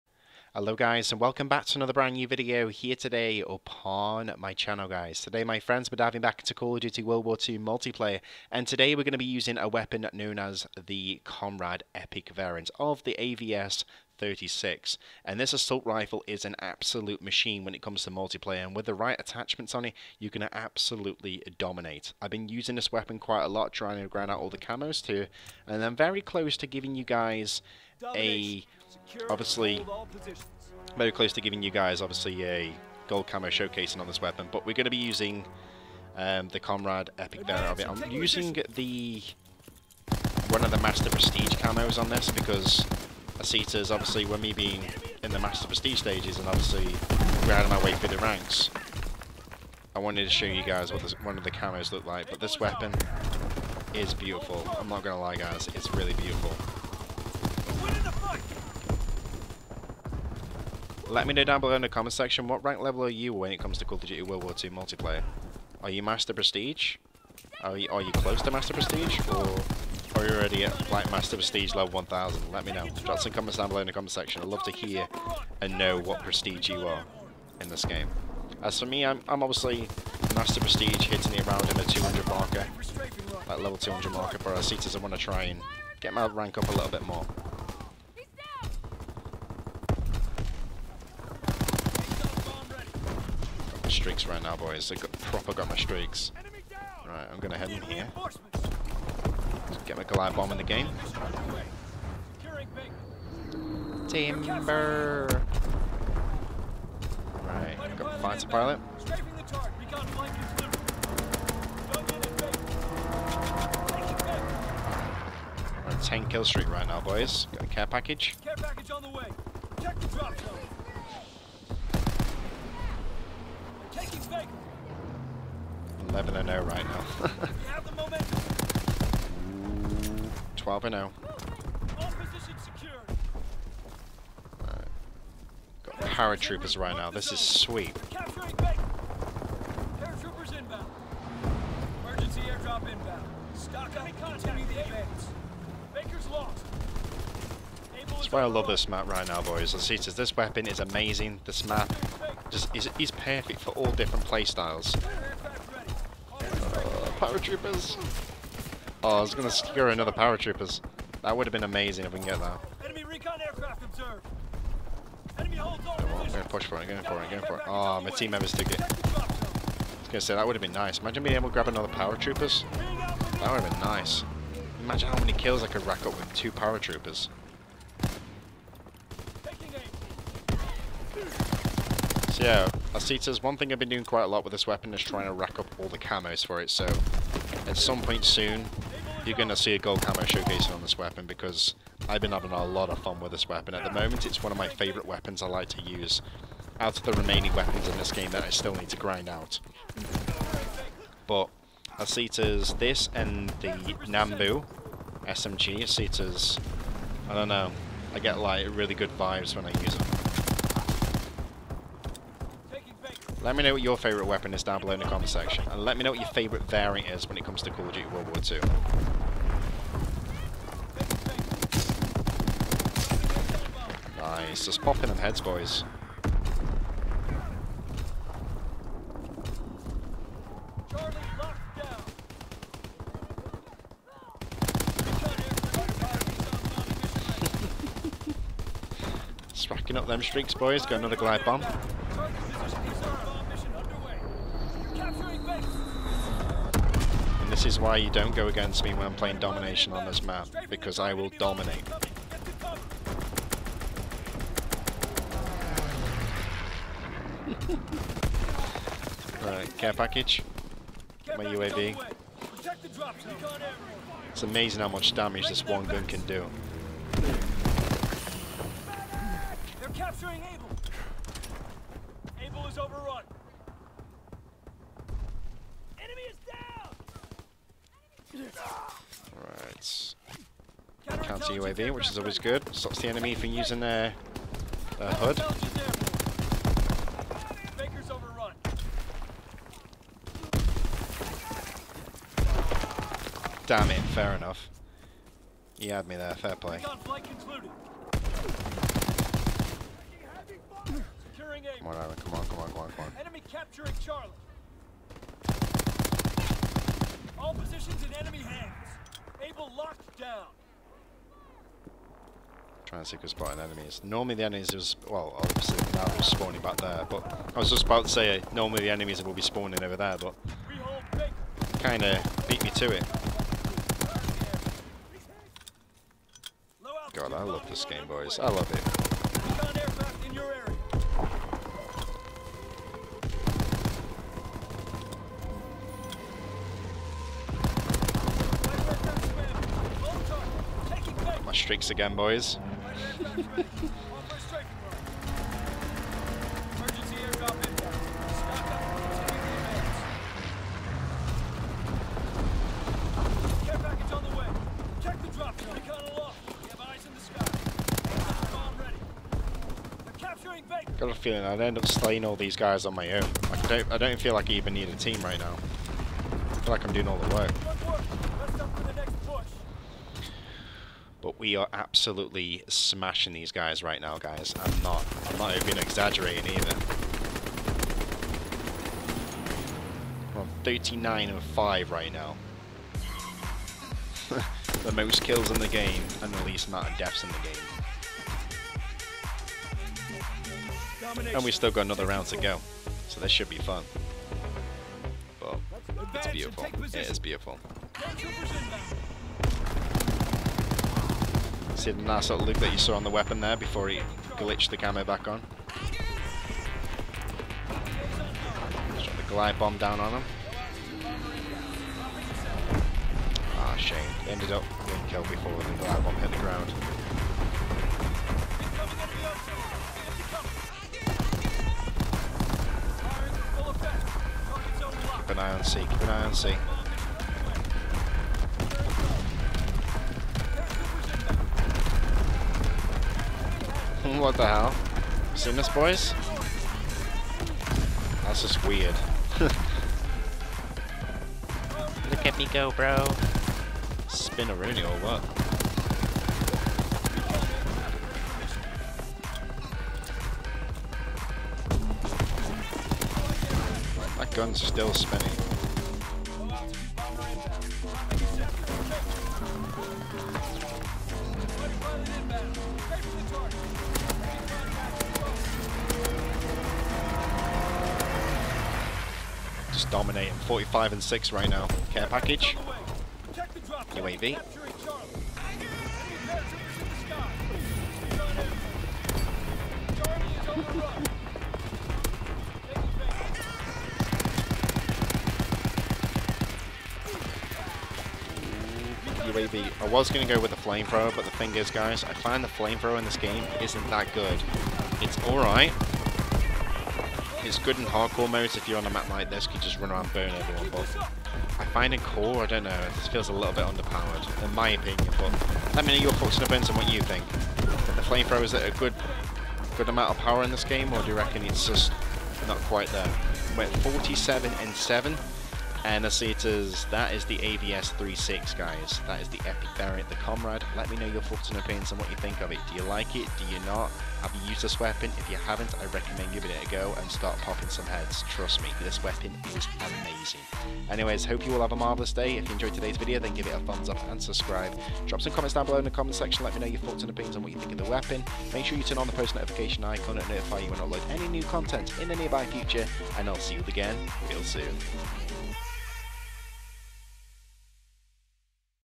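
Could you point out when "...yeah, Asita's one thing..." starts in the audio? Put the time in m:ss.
3:02.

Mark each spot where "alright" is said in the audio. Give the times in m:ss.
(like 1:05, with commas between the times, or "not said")
4:19, 8:15.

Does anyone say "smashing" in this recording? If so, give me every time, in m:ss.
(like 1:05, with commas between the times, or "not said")
6:12.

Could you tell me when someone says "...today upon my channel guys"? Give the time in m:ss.
0:02.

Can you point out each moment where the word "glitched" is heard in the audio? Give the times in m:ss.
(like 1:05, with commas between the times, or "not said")
6:44.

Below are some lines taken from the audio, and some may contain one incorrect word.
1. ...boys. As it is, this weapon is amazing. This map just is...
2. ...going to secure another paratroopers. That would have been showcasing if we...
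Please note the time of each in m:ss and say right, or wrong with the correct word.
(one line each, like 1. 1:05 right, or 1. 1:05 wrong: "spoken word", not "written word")
1. 2:29 right
2. 2:39 wrong: "amazing", not "showcasing".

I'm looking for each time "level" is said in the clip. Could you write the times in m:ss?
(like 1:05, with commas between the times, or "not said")
1:02, 1:11, 1:23.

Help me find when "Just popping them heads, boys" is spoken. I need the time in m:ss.
3:44.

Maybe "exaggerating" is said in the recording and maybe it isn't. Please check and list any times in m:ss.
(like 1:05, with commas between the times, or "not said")
6:15.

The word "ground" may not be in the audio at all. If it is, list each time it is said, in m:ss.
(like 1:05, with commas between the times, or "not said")
6:56.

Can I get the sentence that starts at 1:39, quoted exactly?
Just get my Goliath bomb in the game.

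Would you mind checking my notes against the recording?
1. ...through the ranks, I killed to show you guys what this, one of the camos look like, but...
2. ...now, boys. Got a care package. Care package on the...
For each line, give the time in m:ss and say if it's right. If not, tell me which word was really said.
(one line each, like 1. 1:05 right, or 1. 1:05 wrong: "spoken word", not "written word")
1. 0:47 wrong: "wanted", not "killed"
2. 1:56 right.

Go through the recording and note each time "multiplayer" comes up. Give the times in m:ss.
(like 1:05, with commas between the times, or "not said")
0:07, 0:18, 1:04.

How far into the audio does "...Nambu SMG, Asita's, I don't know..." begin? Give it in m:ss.
3:24.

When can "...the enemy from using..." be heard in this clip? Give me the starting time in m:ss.
4:43.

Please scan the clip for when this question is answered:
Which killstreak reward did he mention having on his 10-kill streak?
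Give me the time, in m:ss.
1:48.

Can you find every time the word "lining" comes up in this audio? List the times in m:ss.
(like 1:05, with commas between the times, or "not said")
not said.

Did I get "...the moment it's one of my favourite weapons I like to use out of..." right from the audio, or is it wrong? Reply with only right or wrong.
right.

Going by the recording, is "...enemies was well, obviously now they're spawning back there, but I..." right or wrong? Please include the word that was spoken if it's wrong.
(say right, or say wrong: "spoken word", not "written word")
right.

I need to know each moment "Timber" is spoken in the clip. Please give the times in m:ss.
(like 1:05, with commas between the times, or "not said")
1:44.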